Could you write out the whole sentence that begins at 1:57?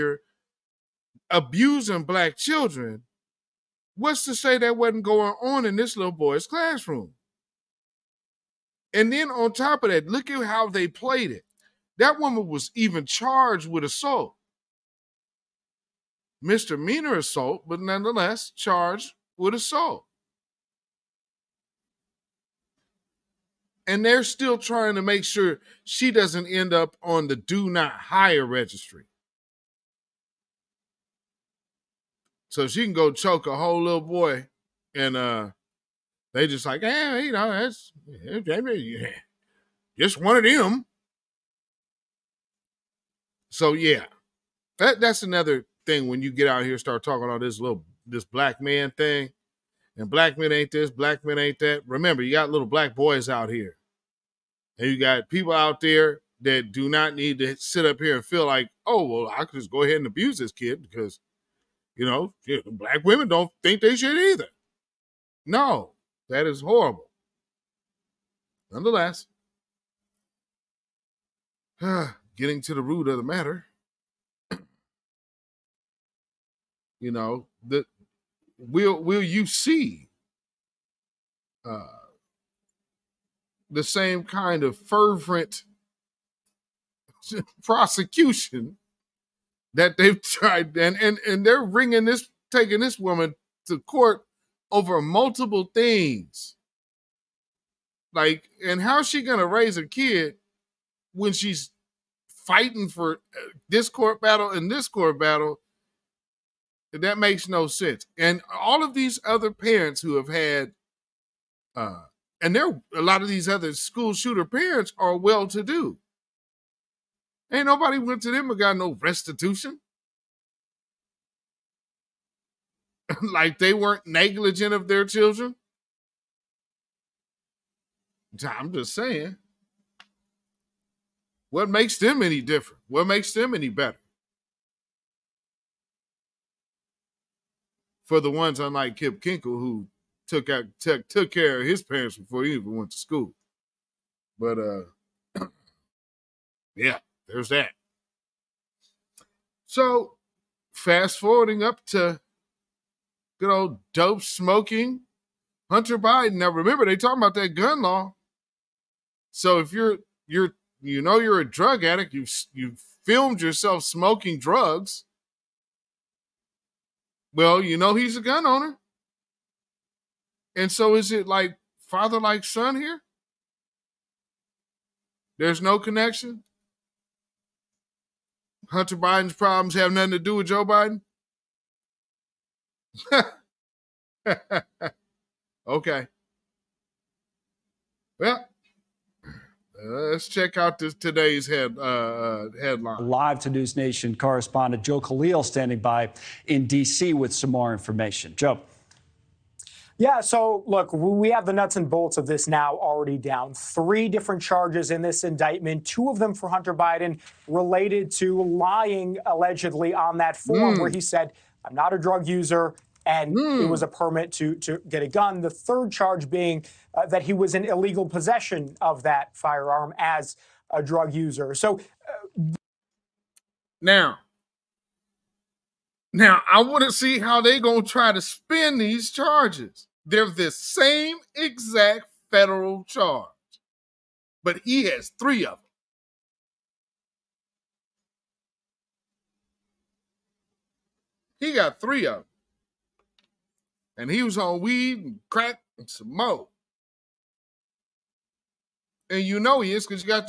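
Ain't nobody went to them and got no restitution.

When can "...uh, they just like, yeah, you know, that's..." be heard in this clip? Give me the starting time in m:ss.
0:35.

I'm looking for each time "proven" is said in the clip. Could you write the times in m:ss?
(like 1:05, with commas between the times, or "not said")
not said.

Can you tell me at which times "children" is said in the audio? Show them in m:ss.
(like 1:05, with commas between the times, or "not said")
0:02, 2:05.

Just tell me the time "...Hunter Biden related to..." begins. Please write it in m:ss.
3:26.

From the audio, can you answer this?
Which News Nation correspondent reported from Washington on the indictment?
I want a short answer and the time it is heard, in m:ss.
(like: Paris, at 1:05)
Joe Khalil, at 3:14.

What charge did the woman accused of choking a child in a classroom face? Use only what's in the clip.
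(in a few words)
Misdemeanor assault.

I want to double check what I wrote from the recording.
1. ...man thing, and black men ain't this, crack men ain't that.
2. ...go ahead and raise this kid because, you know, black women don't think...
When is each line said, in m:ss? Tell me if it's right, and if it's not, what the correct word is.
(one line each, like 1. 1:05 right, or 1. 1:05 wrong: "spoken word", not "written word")
1. 0:48 wrong: "black", not "crack"
2. 0:59 wrong: "abuse", not "raise".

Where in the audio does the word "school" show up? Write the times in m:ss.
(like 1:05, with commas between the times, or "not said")
1:53, 2:22.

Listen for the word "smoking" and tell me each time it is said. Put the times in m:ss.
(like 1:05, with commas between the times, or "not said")
2:34, 2:43.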